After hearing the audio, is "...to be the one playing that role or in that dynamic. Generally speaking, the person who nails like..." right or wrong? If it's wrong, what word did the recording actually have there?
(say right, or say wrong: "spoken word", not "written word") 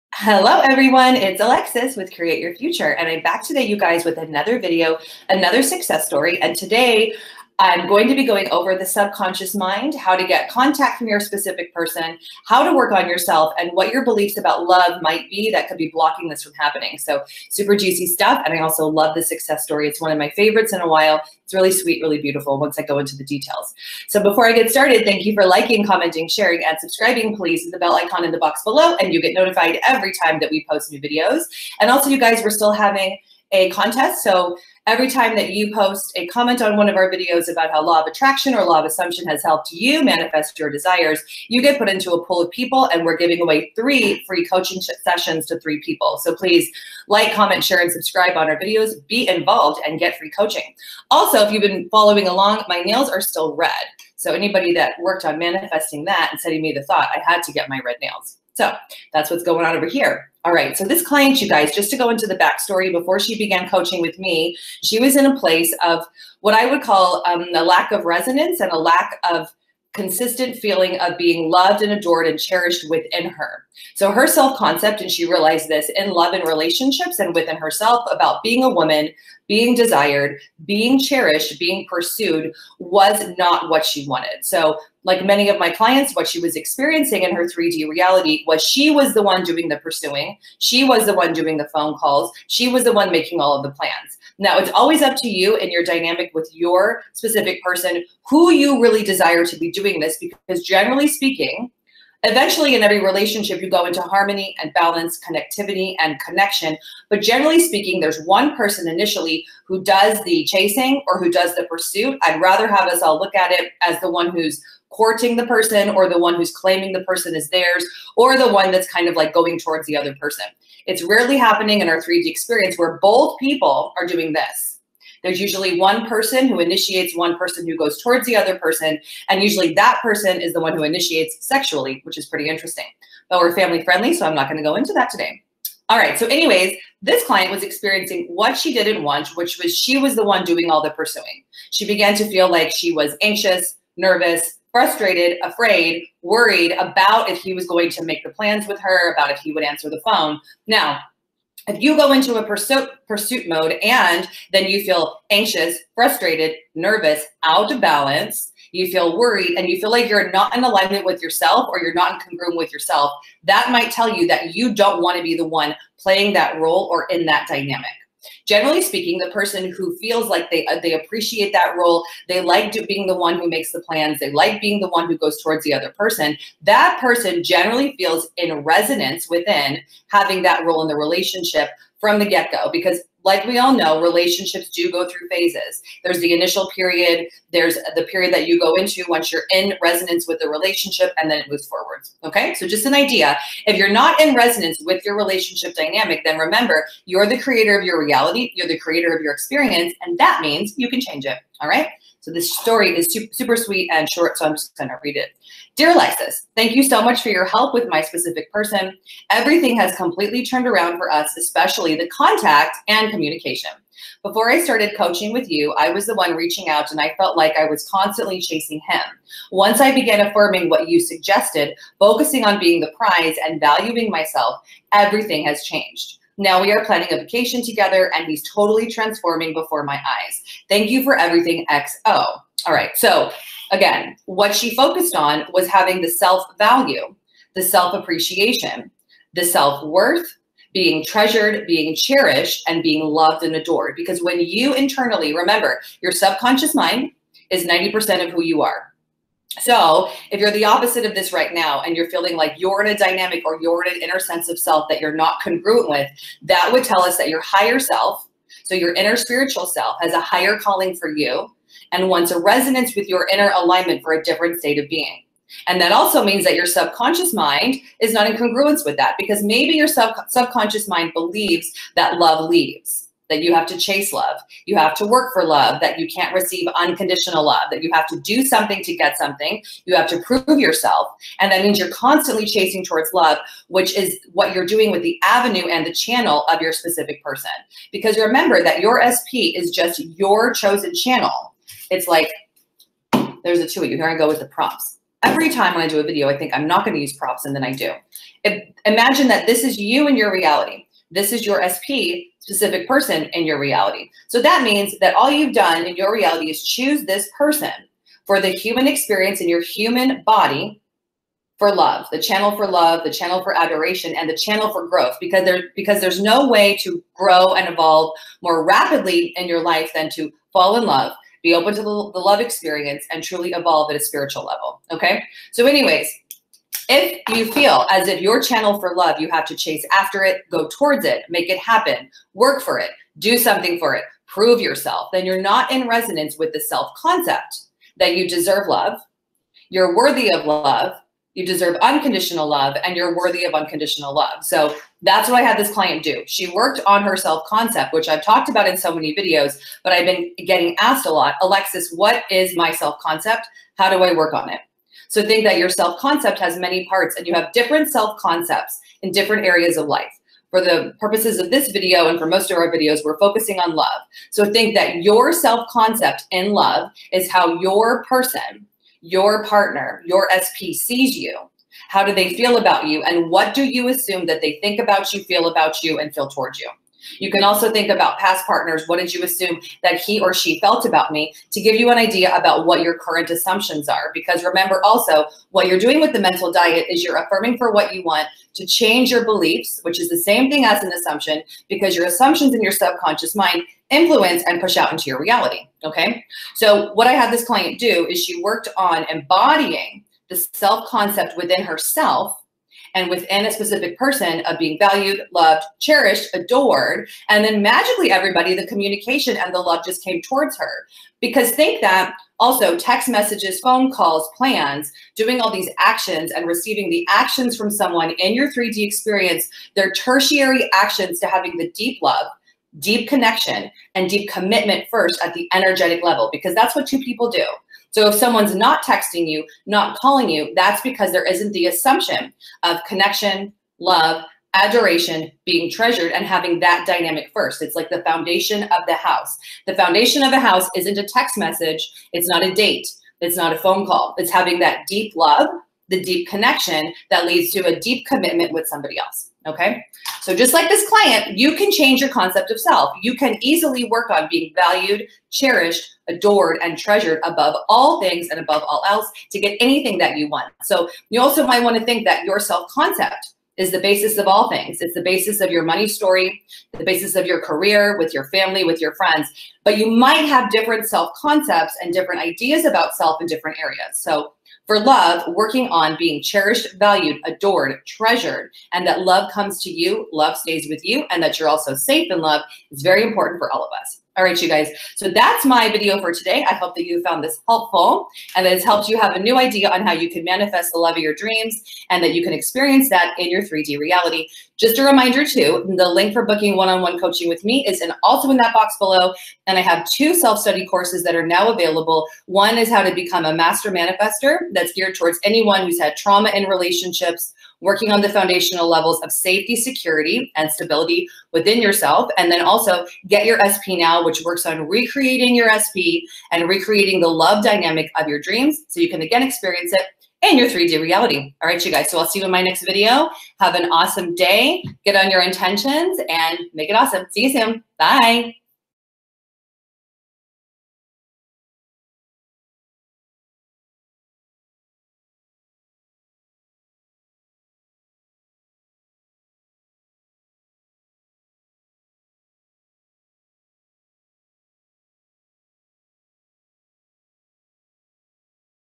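wrong: "feels", not "nails".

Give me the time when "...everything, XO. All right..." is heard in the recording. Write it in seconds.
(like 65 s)
231 s.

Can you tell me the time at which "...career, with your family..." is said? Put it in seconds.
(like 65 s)
467 s.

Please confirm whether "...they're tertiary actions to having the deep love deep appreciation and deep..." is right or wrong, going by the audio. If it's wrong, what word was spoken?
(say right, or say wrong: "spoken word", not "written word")
wrong: "connection", not "appreciation".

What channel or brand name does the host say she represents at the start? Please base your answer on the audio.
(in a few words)
Create Your Future.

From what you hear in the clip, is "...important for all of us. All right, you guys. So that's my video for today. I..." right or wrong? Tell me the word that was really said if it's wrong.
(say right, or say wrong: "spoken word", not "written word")
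right.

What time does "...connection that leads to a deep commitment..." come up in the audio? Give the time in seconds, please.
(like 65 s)
446 s.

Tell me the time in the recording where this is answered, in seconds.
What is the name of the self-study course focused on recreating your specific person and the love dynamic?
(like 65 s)
513 s.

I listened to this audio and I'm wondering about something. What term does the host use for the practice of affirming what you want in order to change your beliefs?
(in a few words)
Mental diet.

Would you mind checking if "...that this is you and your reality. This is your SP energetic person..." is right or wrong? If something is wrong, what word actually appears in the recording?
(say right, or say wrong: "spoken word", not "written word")
wrong: "specific", not "energetic".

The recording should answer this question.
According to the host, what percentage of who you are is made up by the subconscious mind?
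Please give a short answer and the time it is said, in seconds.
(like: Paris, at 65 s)
90%, at 247 s.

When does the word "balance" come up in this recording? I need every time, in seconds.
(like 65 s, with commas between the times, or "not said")
104 s, 157 s.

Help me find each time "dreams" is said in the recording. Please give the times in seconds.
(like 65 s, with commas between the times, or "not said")
491 s, 518 s.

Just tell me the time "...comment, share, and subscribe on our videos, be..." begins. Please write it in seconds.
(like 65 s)
47 s.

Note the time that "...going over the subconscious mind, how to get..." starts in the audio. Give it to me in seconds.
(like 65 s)
8 s.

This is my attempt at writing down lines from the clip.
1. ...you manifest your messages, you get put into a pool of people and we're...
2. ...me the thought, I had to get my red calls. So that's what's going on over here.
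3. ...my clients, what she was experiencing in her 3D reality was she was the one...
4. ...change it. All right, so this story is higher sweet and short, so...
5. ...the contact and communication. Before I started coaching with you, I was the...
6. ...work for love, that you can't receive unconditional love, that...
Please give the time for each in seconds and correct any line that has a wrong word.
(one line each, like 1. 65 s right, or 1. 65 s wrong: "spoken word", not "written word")
1. 39 s wrong: "desires", not "messages"
2. 56 s wrong: "nails", not "calls"
3. 85 s right
4. 201 s wrong: "super", not "higher"
5. 211 s right
6. 275 s right.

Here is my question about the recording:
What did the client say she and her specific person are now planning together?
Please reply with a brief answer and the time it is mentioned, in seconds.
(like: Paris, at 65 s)
A vacation, at 227 s.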